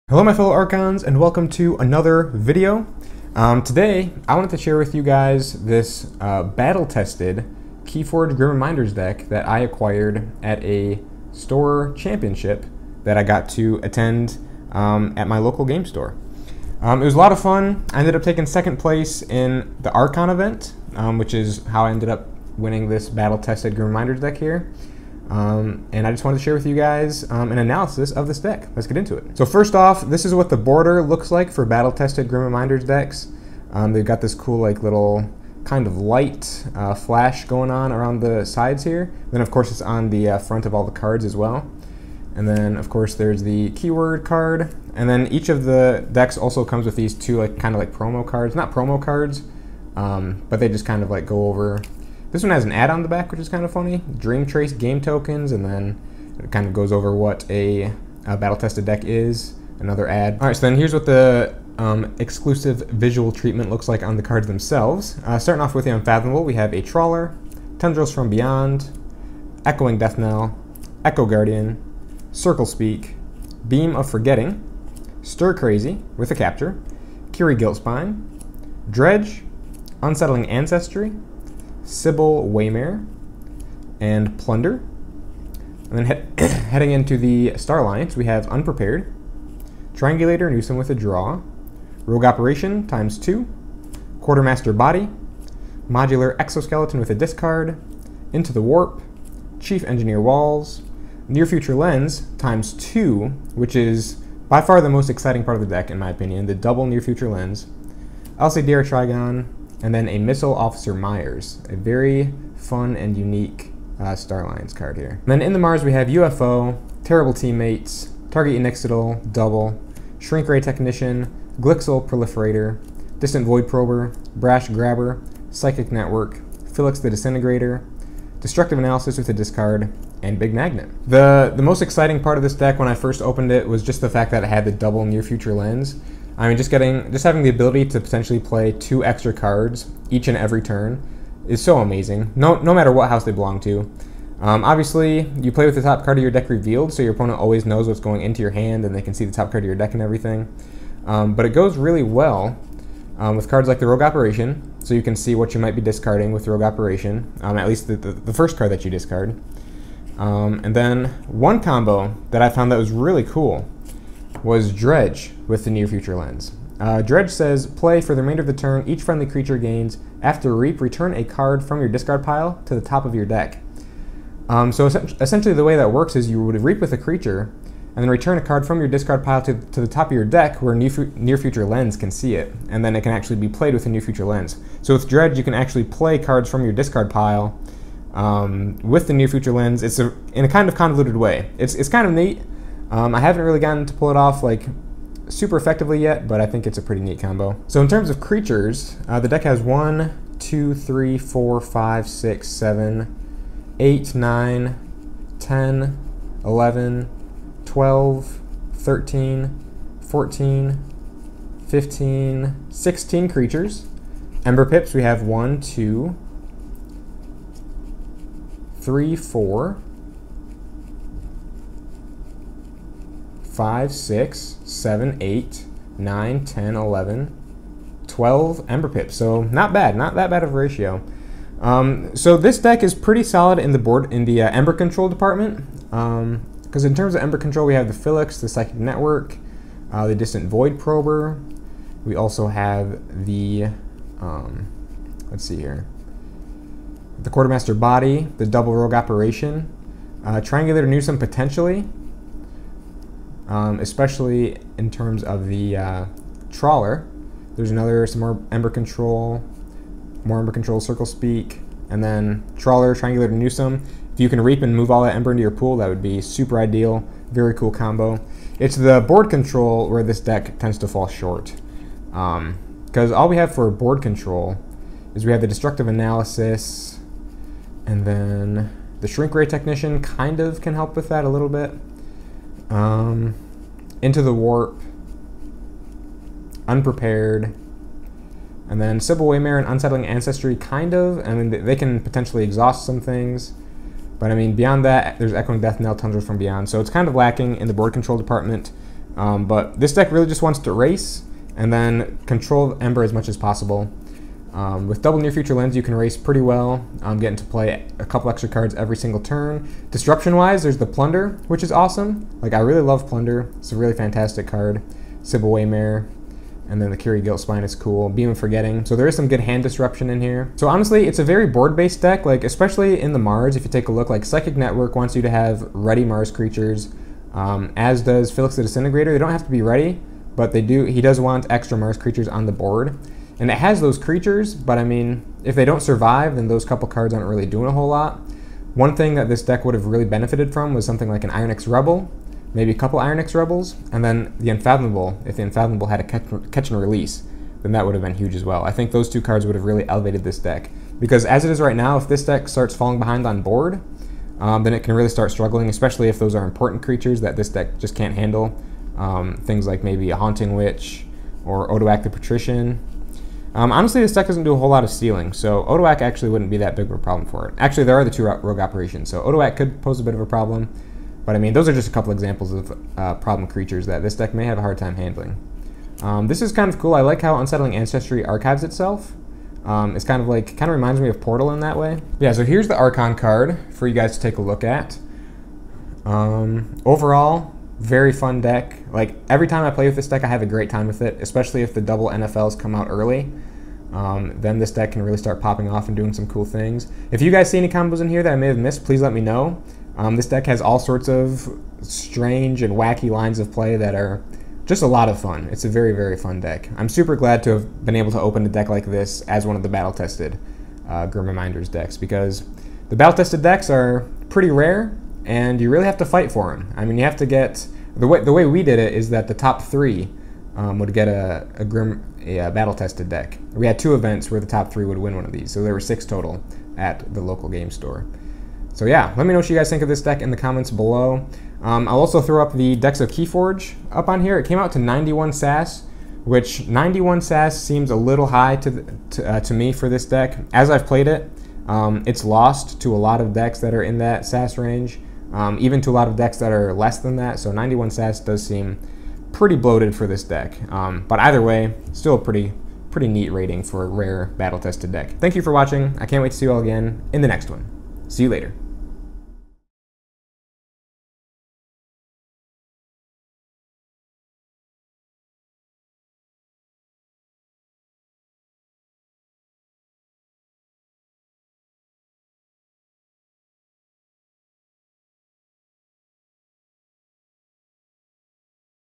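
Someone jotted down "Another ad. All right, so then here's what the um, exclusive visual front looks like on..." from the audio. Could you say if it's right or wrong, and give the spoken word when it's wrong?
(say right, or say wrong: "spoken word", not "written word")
wrong: "treatment", not "front".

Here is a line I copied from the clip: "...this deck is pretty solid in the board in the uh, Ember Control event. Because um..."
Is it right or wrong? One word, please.
wrong.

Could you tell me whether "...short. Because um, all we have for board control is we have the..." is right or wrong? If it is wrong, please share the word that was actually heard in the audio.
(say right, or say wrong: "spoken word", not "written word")
right.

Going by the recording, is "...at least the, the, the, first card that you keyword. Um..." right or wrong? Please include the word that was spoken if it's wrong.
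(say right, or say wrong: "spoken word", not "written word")
wrong: "discard", not "keyword".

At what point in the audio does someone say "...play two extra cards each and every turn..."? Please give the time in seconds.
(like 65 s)
138 s.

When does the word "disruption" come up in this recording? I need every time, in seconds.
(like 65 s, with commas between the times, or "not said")
309 s, 319 s.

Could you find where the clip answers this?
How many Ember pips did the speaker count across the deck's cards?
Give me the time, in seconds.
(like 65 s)
228 s.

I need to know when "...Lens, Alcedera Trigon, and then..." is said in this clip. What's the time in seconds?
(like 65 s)
107 s.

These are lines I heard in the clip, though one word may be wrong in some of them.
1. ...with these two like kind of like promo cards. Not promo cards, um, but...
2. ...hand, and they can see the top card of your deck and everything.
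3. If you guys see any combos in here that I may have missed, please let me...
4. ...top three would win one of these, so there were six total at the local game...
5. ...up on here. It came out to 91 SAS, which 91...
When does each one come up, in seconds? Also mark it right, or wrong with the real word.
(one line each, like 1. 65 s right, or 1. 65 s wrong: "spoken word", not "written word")
1. 46 s right
2. 148 s right
3. 397 s right
4. 424 s right
5. 433 s right.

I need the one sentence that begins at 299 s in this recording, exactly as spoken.
Um, but this deck really just wants to race and then control Ember as much as possible.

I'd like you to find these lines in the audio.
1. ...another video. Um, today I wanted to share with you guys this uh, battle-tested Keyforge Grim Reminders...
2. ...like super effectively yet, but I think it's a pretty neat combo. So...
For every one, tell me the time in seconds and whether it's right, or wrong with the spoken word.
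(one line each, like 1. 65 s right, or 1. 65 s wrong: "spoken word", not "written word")
1. 1 s right
2. 194 s right.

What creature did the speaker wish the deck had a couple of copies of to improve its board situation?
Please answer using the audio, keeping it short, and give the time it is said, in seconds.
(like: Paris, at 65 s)
Ironyx Rebel, at 341 s.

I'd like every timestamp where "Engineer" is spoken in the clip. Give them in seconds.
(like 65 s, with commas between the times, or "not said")
99 s.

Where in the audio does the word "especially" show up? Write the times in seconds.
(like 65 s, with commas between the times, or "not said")
253 s, 322 s, 355 s, 391 s.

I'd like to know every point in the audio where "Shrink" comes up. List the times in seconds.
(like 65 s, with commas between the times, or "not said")
120 s, 279 s.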